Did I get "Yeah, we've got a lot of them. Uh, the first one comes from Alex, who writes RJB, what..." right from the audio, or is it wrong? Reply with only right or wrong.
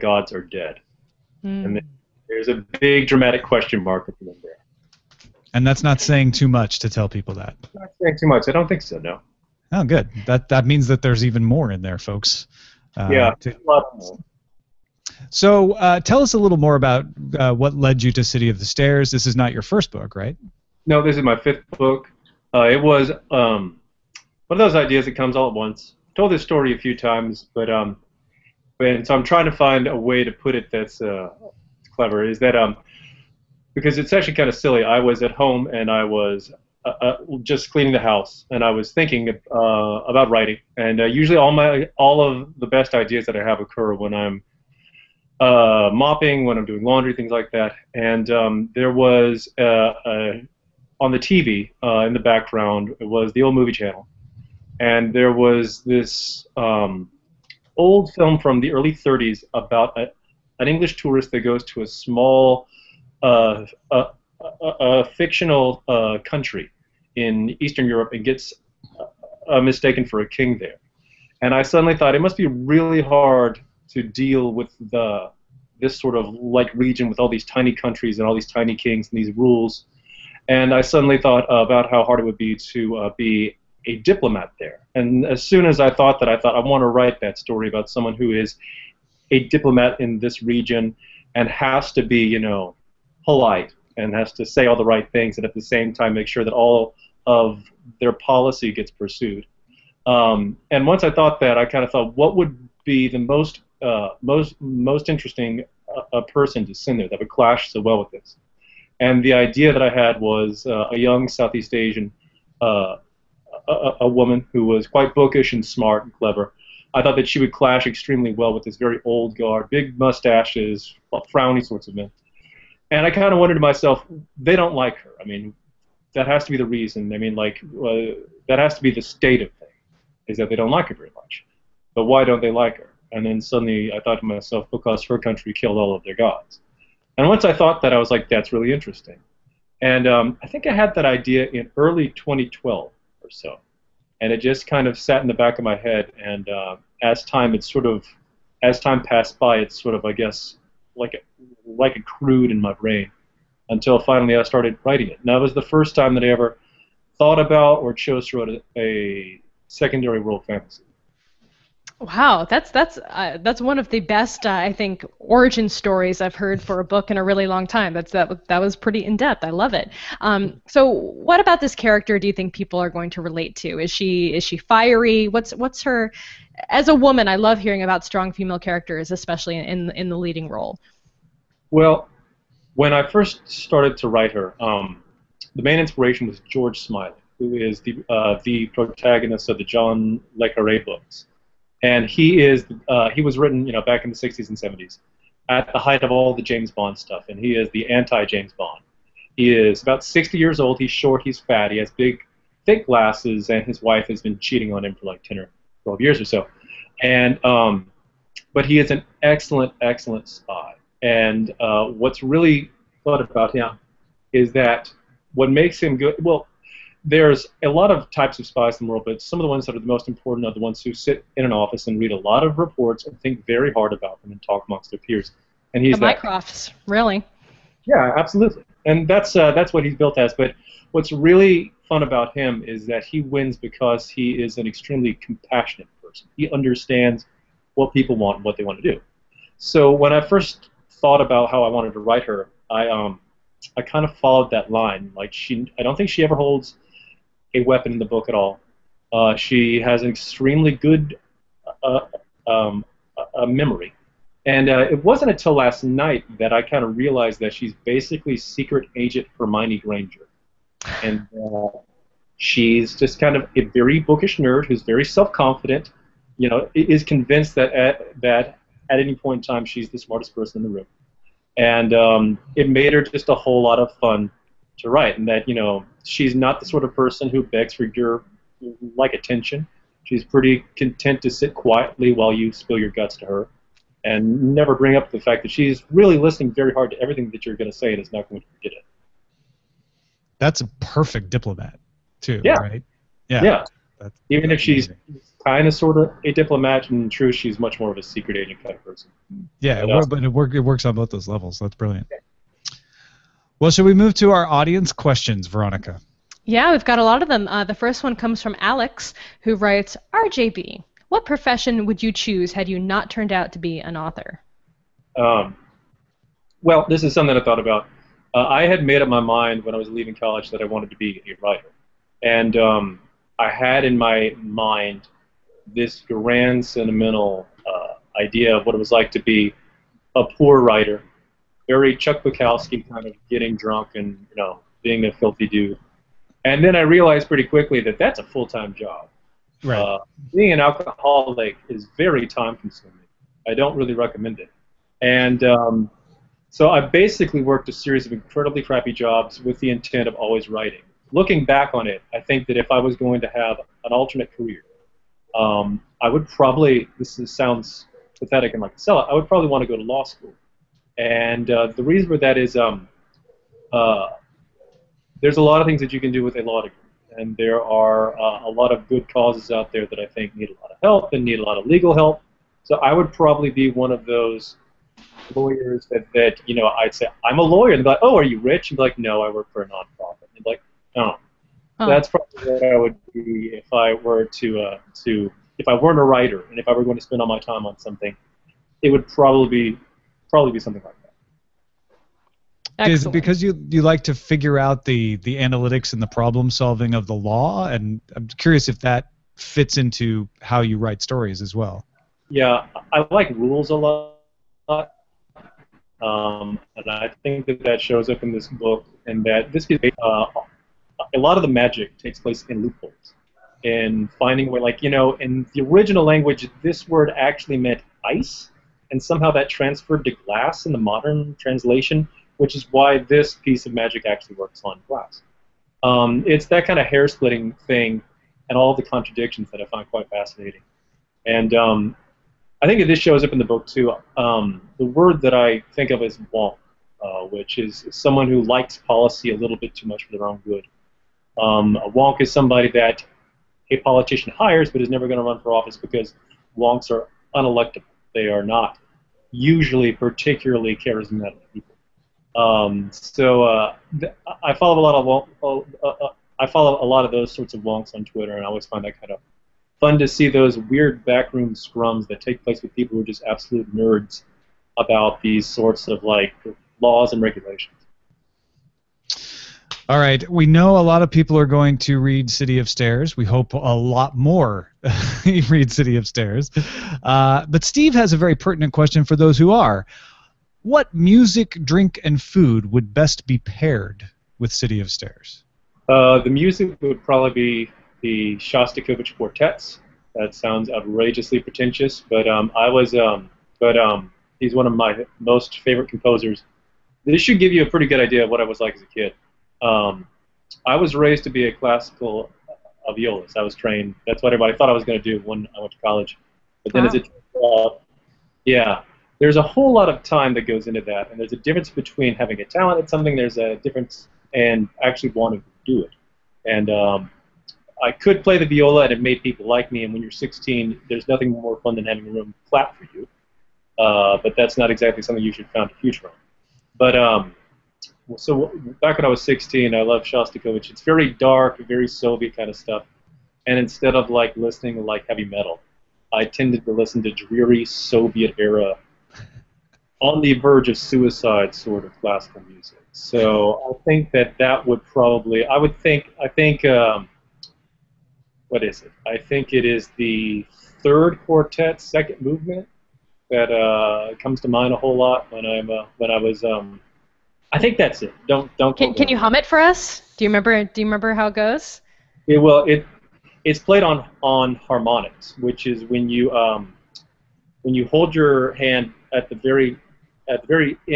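right.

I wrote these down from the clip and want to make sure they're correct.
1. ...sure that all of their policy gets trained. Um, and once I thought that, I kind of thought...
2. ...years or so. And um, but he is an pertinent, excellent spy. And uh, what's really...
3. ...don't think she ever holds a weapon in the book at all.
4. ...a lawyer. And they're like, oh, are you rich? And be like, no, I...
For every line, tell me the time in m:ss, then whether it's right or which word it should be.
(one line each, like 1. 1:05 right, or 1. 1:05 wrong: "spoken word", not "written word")
1. 1:36 wrong: "pursued", not "trained"
2. 3:26 wrong: "excellent", not "pertinent"
3. 4:05 right
4. 6:17 right.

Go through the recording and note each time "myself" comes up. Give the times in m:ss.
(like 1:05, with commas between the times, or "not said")
2:03, 2:14.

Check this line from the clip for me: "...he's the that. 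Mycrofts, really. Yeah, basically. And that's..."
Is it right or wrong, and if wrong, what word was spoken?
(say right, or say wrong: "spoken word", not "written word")
wrong: "absolutely", not "basically".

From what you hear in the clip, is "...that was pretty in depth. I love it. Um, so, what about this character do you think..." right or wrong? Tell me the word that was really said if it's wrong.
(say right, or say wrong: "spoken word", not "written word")
right.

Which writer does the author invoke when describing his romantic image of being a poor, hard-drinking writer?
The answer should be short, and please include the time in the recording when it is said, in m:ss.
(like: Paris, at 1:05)
Chuck Bukowski, at 5:31.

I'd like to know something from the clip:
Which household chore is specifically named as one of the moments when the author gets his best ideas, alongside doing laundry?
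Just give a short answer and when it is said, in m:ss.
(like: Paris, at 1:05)
Mopping, at 0:45.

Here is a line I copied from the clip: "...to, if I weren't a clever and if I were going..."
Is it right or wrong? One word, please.
wrong.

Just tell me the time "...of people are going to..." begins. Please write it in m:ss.
7:51.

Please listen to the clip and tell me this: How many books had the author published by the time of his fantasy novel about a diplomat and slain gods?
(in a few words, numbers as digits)
5.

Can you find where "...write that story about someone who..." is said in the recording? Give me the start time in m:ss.
1:26.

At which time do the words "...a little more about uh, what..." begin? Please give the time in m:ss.
0:16.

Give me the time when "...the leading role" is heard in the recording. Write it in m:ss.
3:00.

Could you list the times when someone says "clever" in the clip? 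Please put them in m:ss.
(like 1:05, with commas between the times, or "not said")
0:31, 1:56.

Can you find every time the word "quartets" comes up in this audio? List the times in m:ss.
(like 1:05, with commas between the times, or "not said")
8:09, 9:11.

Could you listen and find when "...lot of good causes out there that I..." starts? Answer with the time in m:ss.
6:08.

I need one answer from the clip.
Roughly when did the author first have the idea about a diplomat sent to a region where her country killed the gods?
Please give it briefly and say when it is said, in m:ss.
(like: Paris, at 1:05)
Early 2012, at 2:21.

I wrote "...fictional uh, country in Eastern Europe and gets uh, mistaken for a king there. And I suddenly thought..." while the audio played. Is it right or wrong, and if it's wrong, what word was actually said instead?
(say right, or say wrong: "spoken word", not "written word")
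right.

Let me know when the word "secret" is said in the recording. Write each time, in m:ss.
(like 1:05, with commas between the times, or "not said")
4:18, 4:58.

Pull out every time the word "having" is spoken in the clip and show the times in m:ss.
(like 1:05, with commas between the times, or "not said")
8:32, 8:41.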